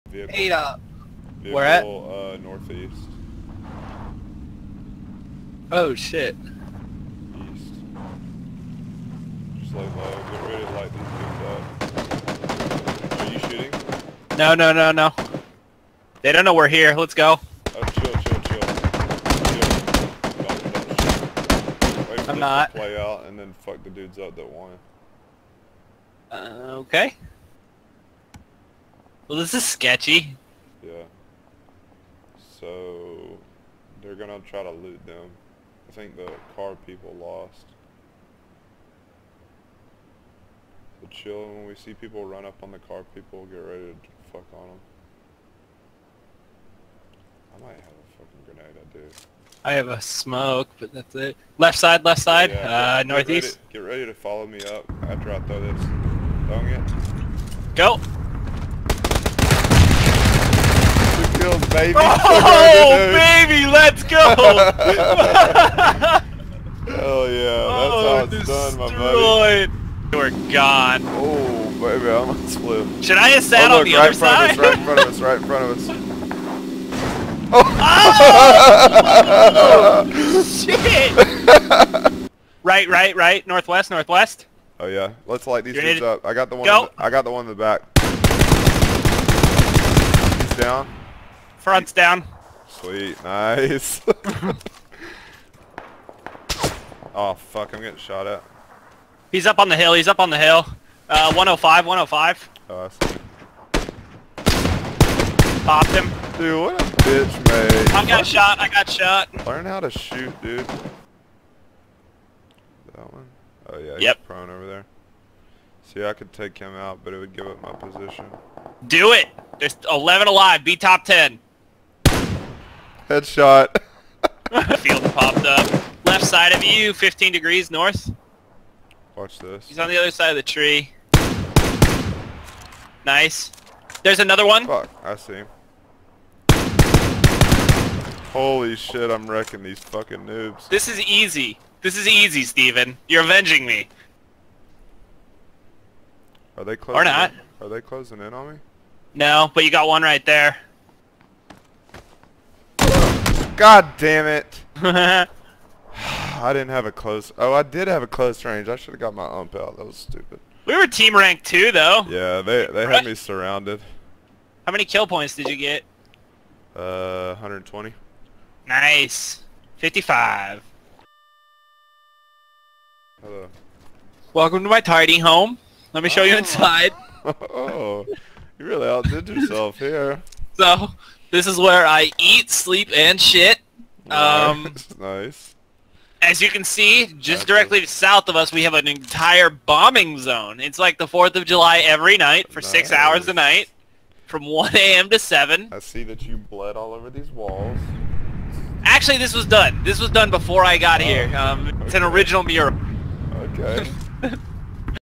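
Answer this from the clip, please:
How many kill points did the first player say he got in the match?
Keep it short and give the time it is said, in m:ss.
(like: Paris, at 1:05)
120, at 2:47.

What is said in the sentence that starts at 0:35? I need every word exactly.
I think the car people lost.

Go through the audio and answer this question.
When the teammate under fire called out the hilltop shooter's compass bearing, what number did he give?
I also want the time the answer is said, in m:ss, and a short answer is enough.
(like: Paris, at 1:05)
105, at 1:41.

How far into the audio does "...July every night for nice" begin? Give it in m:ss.
3:11.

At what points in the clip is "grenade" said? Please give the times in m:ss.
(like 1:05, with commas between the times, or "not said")
0:48.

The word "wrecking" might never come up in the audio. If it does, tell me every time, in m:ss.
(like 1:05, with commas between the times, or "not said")
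2:19.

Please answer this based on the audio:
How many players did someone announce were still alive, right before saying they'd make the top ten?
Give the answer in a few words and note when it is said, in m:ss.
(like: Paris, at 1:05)
11, at 1:59.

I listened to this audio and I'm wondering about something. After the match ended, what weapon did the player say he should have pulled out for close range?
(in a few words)
UMP.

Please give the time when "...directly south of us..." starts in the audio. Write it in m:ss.
3:07.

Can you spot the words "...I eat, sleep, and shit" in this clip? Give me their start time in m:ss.
3:01.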